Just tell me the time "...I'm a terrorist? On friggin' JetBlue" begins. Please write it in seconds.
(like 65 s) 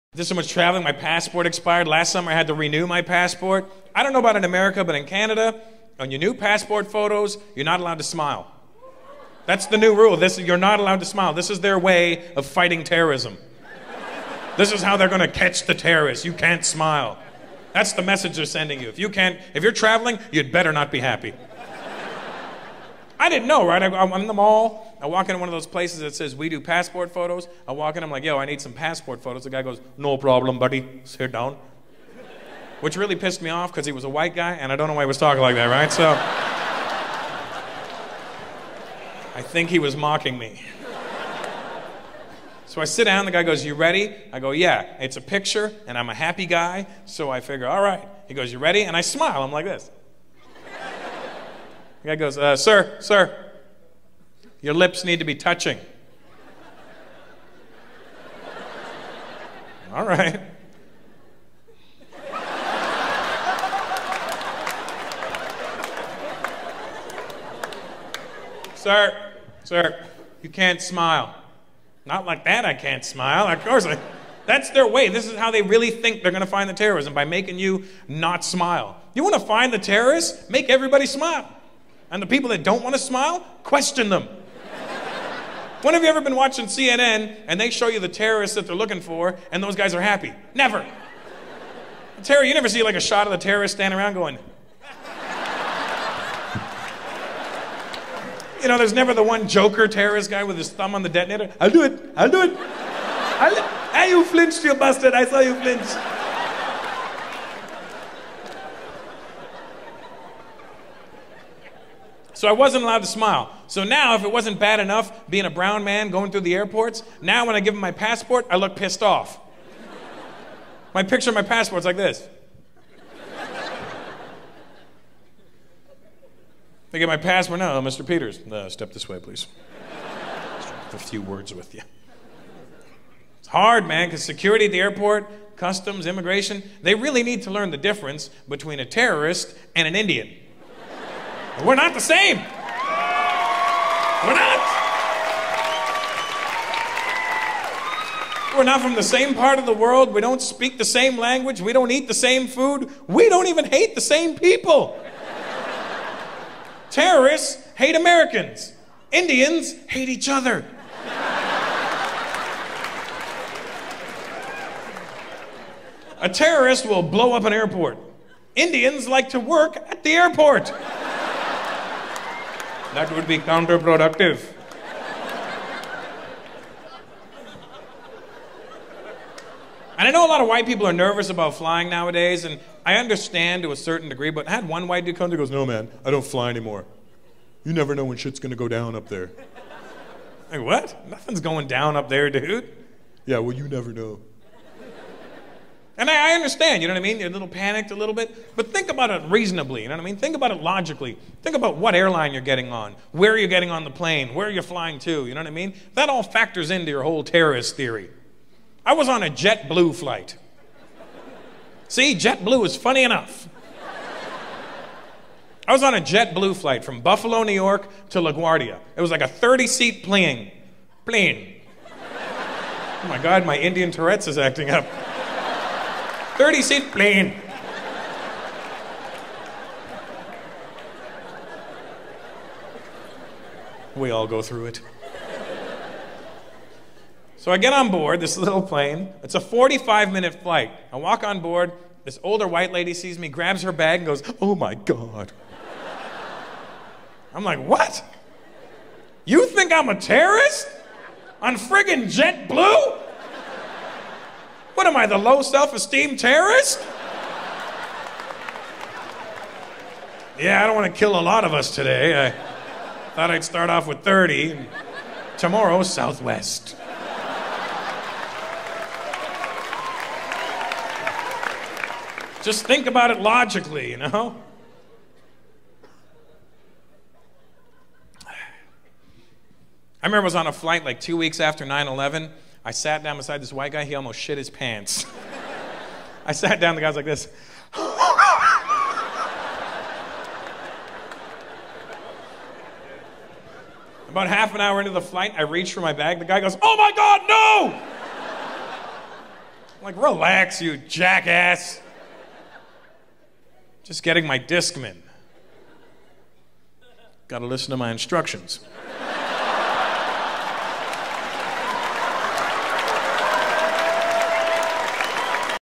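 249 s.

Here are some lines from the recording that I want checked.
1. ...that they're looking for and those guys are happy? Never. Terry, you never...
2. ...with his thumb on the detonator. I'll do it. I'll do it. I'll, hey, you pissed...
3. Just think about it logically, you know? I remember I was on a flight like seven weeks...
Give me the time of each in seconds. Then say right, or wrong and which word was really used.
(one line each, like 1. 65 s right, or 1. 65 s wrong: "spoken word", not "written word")
1. 88 s right
2. 100 s wrong: "flinched", not "pissed"
3. 272 s wrong: "two", not "seven".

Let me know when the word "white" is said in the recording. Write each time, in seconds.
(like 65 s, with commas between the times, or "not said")
34 s, 180 s, 184 s, 242 s, 283 s.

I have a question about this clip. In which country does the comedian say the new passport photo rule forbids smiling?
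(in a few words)
Canada.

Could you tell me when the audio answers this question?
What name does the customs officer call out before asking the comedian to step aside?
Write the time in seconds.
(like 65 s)
127 s.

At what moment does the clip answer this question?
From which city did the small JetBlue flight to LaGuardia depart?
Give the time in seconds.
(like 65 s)
217 s.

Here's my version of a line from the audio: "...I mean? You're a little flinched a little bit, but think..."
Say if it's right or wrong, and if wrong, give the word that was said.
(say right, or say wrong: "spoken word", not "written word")
wrong: "panicked", not "flinched".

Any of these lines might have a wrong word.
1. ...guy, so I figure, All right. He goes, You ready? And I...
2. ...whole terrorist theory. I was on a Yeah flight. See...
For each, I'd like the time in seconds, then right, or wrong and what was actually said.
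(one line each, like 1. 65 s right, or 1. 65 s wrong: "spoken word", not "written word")
1. 46 s right
2. 207 s wrong: "JetBlue", not "Yeah".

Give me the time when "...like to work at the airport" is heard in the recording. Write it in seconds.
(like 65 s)
169 s.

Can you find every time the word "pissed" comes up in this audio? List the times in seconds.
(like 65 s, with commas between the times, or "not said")
33 s, 118 s.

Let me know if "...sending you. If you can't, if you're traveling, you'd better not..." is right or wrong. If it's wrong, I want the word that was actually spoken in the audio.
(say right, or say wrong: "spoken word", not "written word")
right.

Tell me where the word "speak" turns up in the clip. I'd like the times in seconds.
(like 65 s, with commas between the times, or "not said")
150 s.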